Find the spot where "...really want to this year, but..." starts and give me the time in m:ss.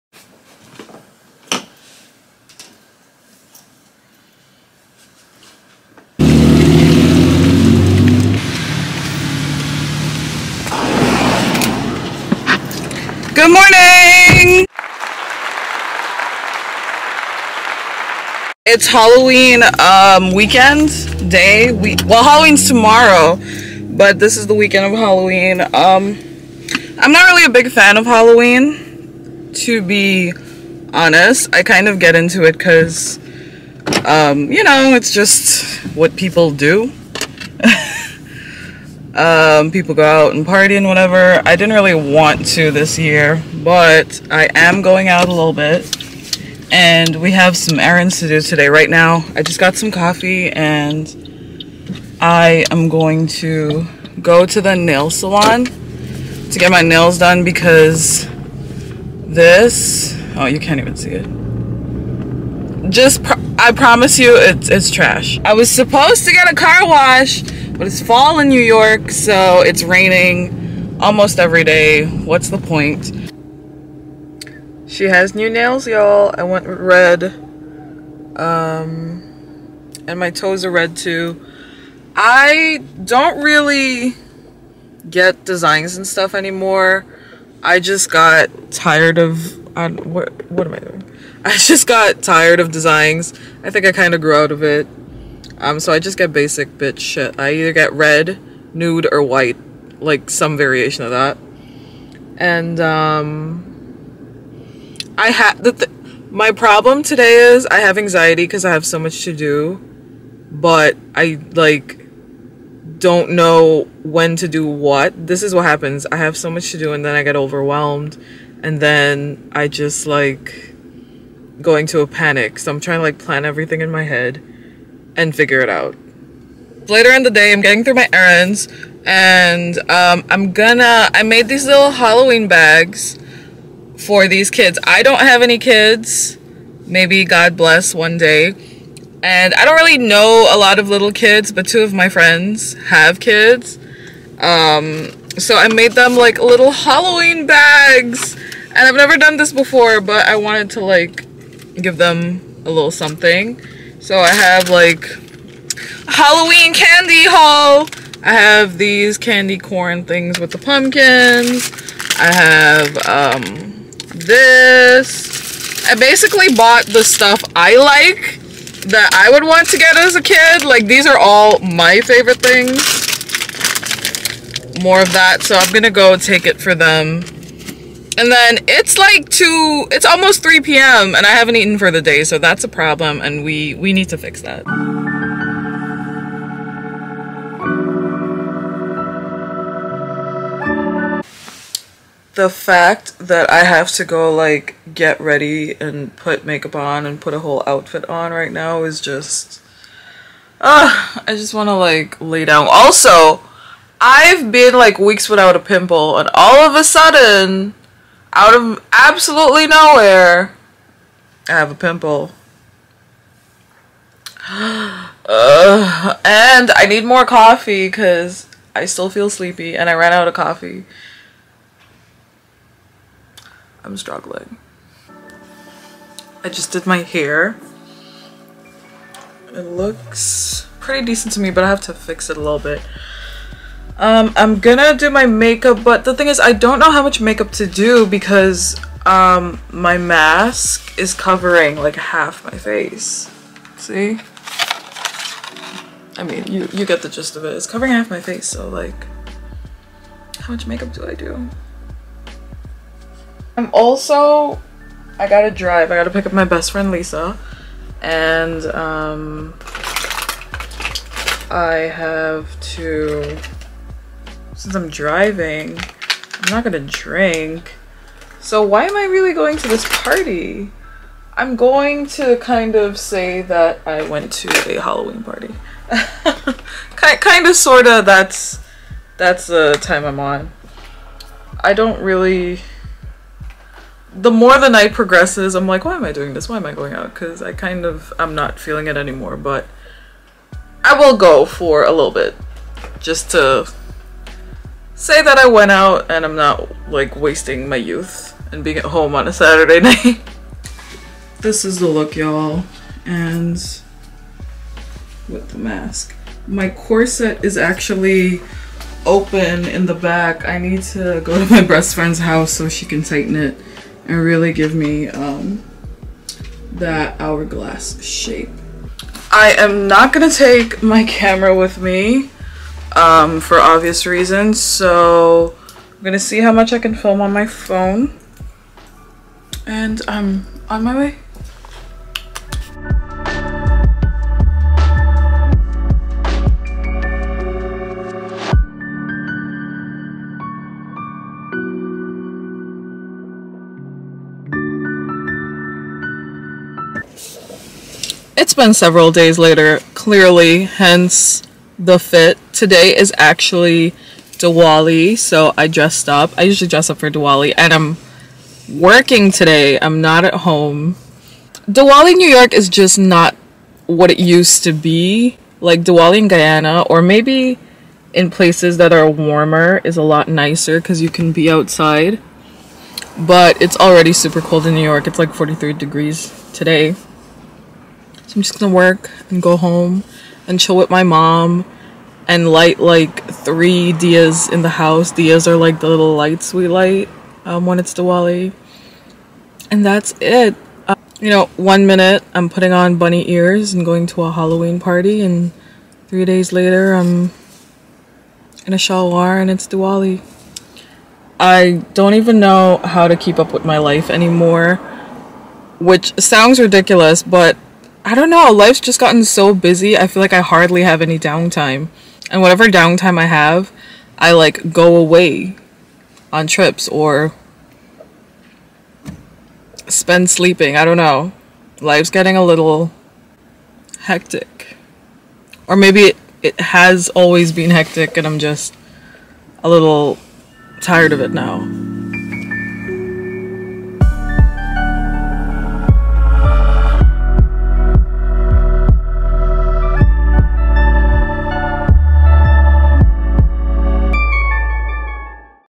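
0:41.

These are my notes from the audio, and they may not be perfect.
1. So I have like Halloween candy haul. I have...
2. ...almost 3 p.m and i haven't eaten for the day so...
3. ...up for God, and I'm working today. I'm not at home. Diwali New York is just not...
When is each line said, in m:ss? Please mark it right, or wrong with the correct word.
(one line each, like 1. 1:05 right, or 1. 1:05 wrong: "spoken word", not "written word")
1. 2:34 right
2. 3:00 right
3. 5:56 wrong: "Diwali", not "God".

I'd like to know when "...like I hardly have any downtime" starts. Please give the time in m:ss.
6:50.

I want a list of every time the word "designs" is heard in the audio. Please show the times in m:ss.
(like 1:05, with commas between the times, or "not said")
1:25, 1:32.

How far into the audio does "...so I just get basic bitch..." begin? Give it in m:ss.
1:35.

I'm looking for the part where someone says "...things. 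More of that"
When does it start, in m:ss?
2:52.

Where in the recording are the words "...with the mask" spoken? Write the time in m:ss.
5:05.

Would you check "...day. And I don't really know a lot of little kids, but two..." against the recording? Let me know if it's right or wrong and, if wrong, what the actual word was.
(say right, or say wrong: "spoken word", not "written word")
right.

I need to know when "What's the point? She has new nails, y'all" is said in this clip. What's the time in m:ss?
1:12.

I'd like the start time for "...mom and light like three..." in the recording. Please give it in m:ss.
6:21.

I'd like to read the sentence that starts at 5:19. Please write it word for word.
I am not gonna take my camera with me um, for obvious reasons.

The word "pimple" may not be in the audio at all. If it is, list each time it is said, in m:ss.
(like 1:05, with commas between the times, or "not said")
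3:25, 3:31.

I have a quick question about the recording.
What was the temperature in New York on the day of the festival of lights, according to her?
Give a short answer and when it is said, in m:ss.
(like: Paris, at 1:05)
43 degrees, at 6:15.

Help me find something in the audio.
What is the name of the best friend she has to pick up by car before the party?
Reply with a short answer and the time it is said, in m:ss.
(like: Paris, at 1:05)
Lisa, at 4:16.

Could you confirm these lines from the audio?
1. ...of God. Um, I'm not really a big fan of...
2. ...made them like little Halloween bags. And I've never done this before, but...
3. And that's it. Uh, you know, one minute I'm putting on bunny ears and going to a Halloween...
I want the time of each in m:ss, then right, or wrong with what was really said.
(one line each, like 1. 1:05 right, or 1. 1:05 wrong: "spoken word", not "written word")
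1. 0:24 wrong: "Halloween", not "God"
2. 2:25 right
3. 6:29 right.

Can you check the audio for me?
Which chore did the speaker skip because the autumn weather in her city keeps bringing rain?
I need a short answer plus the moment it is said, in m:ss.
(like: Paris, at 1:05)
car wash, at 1:06.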